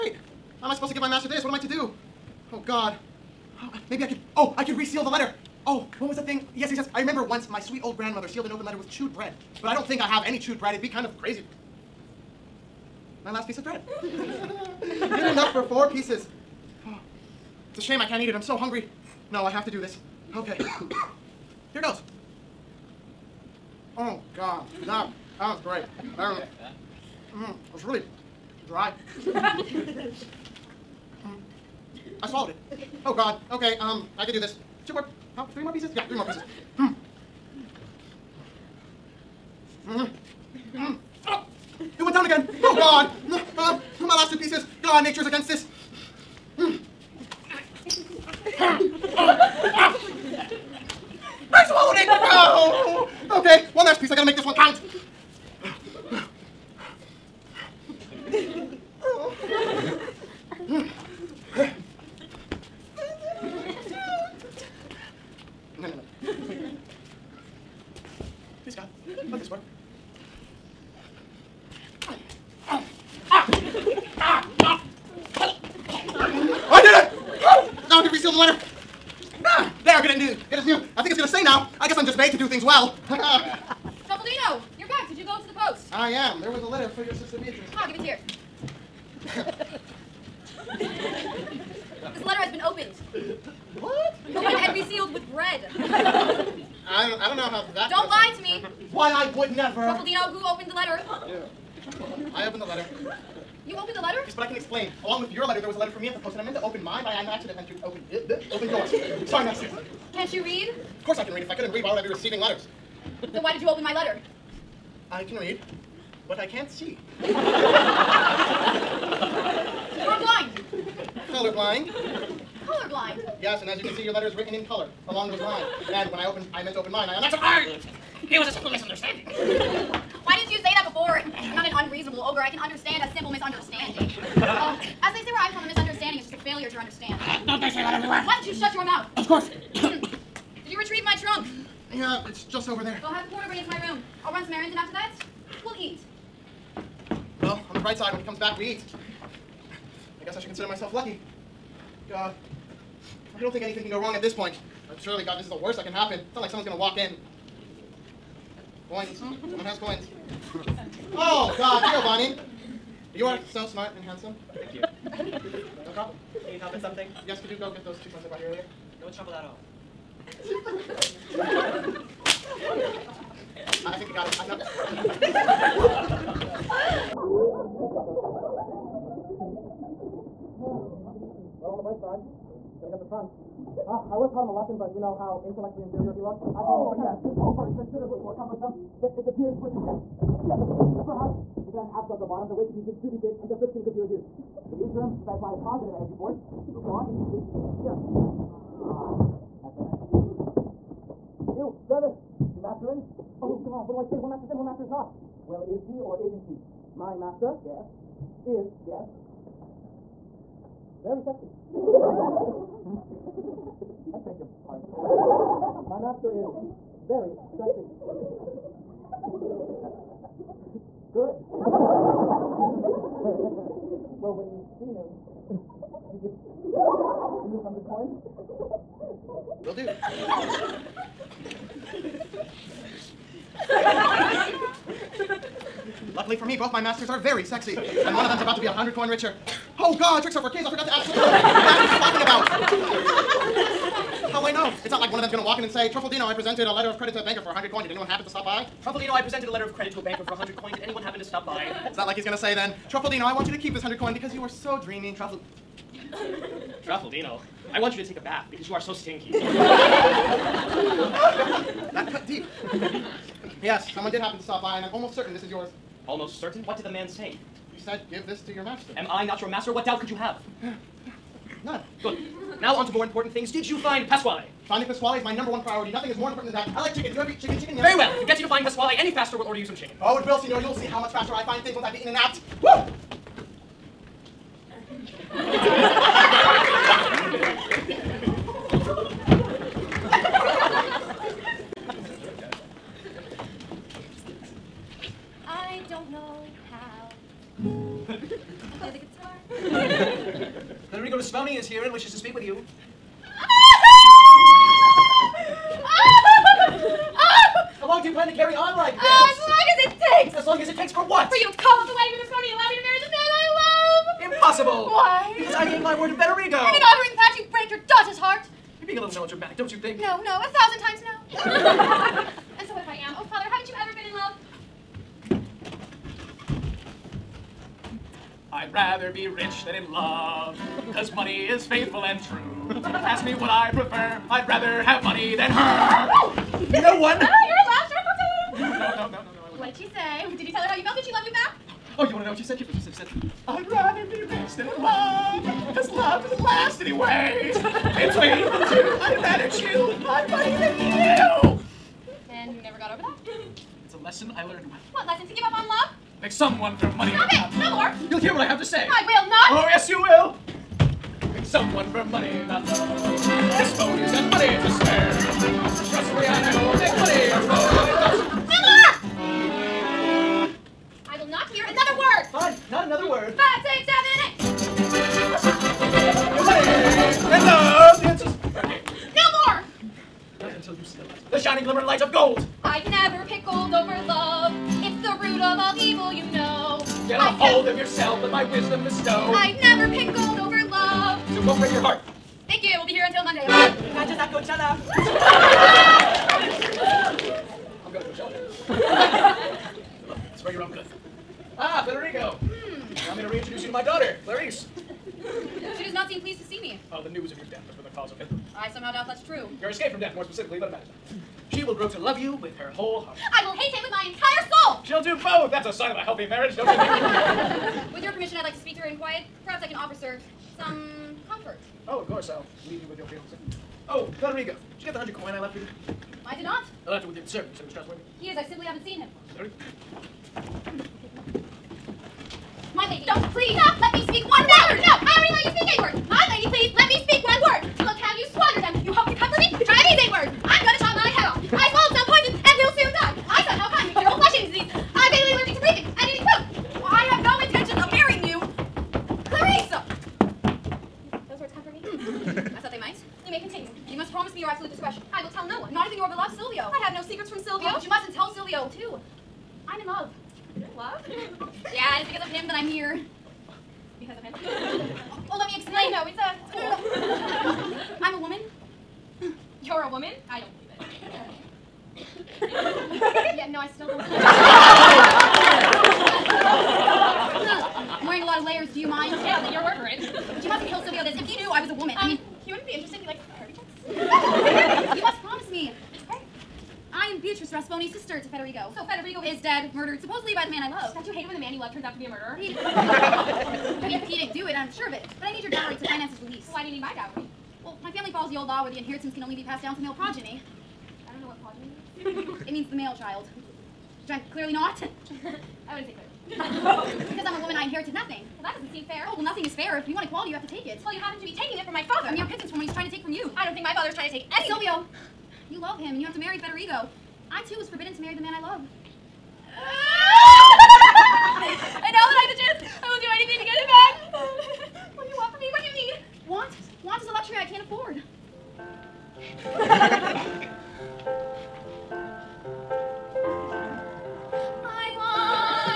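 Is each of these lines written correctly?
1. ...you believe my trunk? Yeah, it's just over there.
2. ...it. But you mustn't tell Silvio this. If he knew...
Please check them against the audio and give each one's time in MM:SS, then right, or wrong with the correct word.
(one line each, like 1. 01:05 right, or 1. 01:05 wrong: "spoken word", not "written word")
1. 02:20 wrong: "retrieve", not "believe"
2. 07:59 right.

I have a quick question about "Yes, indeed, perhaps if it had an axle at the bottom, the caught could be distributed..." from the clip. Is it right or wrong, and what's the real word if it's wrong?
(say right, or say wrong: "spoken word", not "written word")
wrong: "weight", not "caught".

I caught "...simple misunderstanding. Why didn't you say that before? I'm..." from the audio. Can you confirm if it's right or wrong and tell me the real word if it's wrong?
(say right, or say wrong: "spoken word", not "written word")
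right.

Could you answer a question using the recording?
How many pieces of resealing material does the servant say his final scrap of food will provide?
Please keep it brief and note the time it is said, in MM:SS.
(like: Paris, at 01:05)
4, at 00:15.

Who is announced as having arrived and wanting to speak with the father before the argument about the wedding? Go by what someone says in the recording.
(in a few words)
Nicholas Sponey.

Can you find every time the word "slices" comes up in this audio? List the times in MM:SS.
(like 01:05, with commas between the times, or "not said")
02:48.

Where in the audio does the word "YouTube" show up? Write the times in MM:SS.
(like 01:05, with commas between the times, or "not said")
not said.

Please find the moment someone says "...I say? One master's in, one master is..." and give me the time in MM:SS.
03:23.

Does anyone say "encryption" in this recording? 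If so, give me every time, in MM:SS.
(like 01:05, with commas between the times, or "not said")
not said.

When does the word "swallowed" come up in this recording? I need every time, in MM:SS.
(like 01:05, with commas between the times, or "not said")
00:32, 00:51, 07:21.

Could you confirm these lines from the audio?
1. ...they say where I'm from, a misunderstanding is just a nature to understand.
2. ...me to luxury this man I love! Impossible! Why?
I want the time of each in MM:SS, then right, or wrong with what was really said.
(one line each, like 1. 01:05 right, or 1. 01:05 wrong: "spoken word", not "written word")
1. 02:15 wrong: "failure", not "nature"
2. 05:12 wrong: "marry", not "luxury".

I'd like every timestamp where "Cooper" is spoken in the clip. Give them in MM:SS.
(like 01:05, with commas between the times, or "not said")
03:07.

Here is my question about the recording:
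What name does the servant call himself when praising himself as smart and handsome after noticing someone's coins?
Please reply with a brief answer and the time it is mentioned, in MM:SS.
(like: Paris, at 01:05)
Giovanni, at 02:42.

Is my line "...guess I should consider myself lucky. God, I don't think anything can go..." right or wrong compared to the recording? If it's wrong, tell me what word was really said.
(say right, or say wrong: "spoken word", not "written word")
right.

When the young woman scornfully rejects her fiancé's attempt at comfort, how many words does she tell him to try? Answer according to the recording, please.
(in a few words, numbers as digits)
8.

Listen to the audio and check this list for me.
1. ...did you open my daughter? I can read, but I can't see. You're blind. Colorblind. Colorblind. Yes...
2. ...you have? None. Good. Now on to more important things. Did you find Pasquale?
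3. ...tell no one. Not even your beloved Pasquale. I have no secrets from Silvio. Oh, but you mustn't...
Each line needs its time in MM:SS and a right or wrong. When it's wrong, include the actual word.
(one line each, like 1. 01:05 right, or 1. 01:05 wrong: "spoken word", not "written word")
1. 01:53 wrong: "letter", not "daughter"
2. 04:30 right
3. 07:35 wrong: "Silvio", not "Pasquale".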